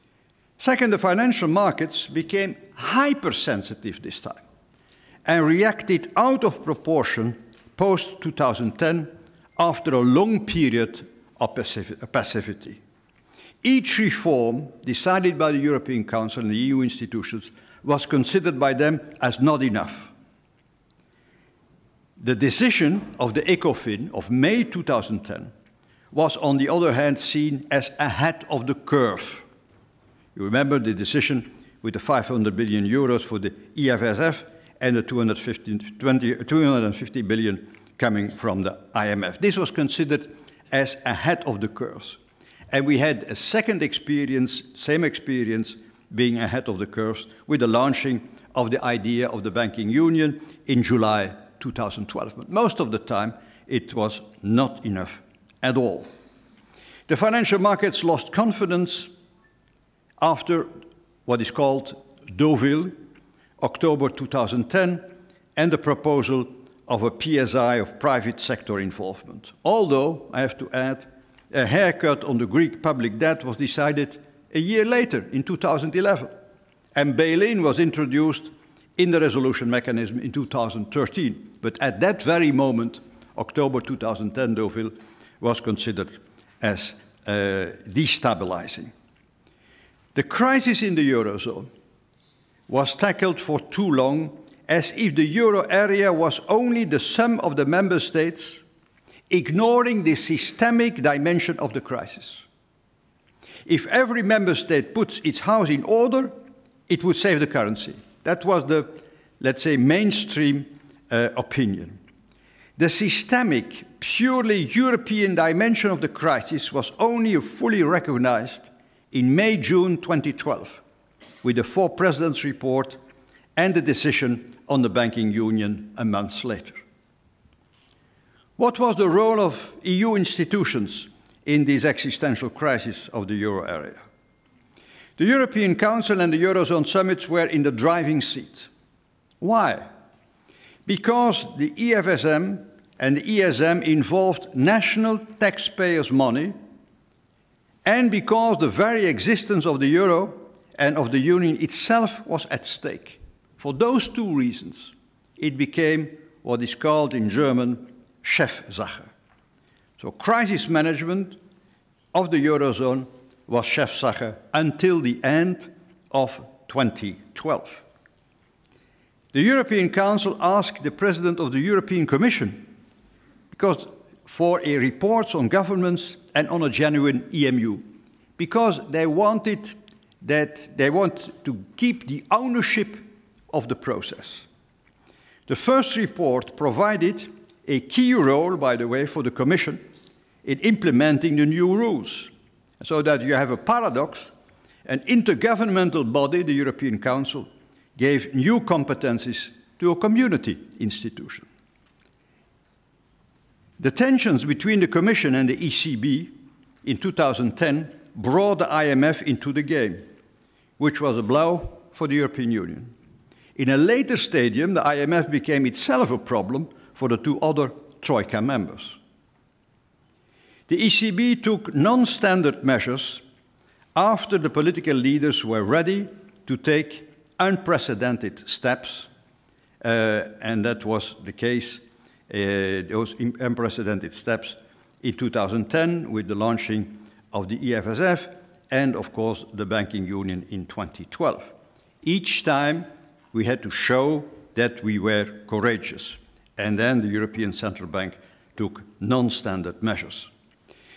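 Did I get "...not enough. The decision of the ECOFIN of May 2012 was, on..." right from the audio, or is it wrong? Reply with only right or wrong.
wrong.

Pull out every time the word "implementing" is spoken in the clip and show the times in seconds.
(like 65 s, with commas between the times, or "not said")
190 s.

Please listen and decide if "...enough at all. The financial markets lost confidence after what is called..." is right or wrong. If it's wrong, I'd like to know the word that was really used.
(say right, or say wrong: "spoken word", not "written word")
right.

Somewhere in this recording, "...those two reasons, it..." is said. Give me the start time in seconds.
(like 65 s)
153 s.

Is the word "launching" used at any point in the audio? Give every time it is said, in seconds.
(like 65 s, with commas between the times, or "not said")
47 s, 236 s.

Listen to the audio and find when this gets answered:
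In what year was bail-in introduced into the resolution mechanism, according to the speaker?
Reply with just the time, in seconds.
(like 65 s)
80 s.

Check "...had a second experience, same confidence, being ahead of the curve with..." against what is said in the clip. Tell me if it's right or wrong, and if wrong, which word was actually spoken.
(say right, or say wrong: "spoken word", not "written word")
wrong: "experience", not "confidence".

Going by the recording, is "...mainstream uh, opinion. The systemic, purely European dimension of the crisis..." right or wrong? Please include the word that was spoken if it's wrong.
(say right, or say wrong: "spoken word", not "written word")
right.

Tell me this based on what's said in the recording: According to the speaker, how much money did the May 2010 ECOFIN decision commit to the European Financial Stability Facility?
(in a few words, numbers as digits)
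500 billion euros.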